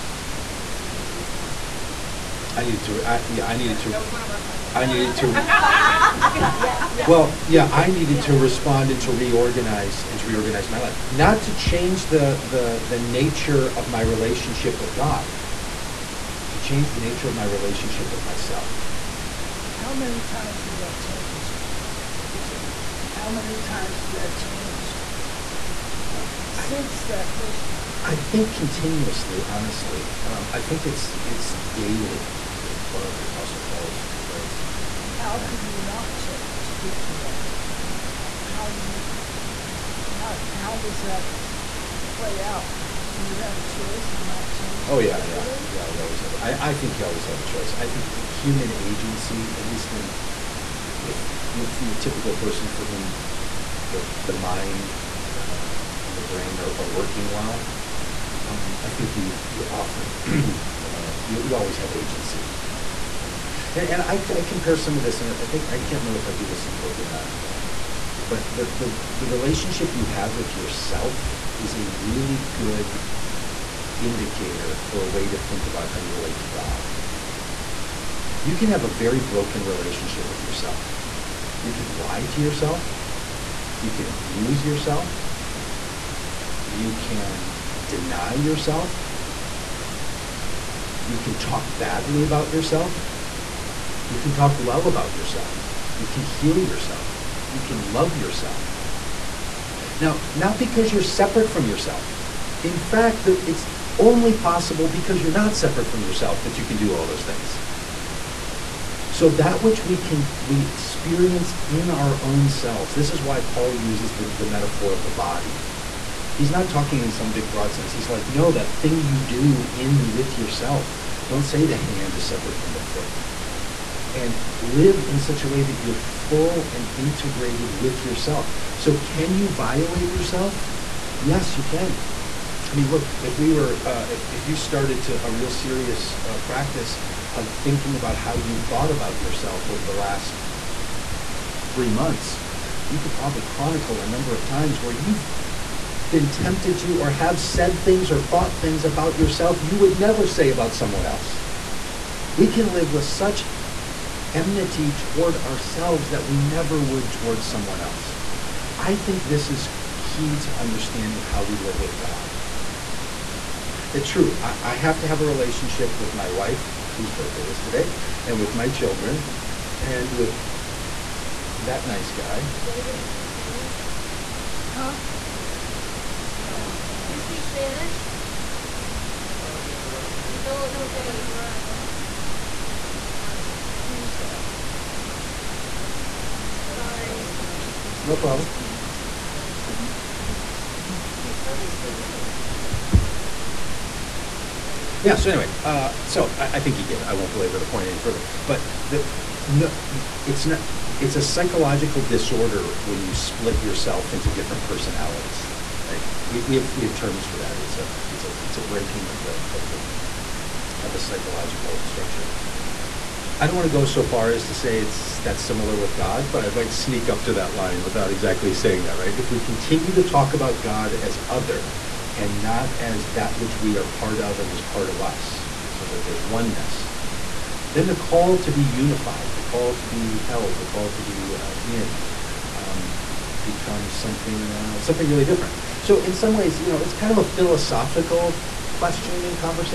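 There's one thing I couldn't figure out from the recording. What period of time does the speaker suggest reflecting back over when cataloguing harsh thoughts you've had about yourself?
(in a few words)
three months.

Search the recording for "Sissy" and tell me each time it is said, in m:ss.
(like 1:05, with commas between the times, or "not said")
not said.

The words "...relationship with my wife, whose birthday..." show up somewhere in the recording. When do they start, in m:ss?
2:45.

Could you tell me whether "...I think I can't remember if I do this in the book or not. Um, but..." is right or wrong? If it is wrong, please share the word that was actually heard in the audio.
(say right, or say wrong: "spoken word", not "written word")
right.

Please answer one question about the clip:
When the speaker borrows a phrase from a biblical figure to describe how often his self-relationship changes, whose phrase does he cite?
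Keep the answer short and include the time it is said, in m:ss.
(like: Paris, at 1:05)
Apostle Paul, at 0:33.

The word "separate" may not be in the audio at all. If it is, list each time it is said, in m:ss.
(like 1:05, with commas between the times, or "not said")
1:41, 1:45, 2:02.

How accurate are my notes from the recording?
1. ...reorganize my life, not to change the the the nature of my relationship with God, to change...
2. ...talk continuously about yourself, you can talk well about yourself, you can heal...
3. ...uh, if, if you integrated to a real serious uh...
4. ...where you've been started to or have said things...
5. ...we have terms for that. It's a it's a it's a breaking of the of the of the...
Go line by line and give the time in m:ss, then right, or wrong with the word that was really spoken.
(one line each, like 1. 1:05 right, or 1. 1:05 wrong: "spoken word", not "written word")
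1. 0:10 right
2. 1:31 wrong: "badly", not "continuously"
3. 2:13 wrong: "started", not "integrated"
4. 2:24 wrong: "tempted", not "started"
5. 3:26 right.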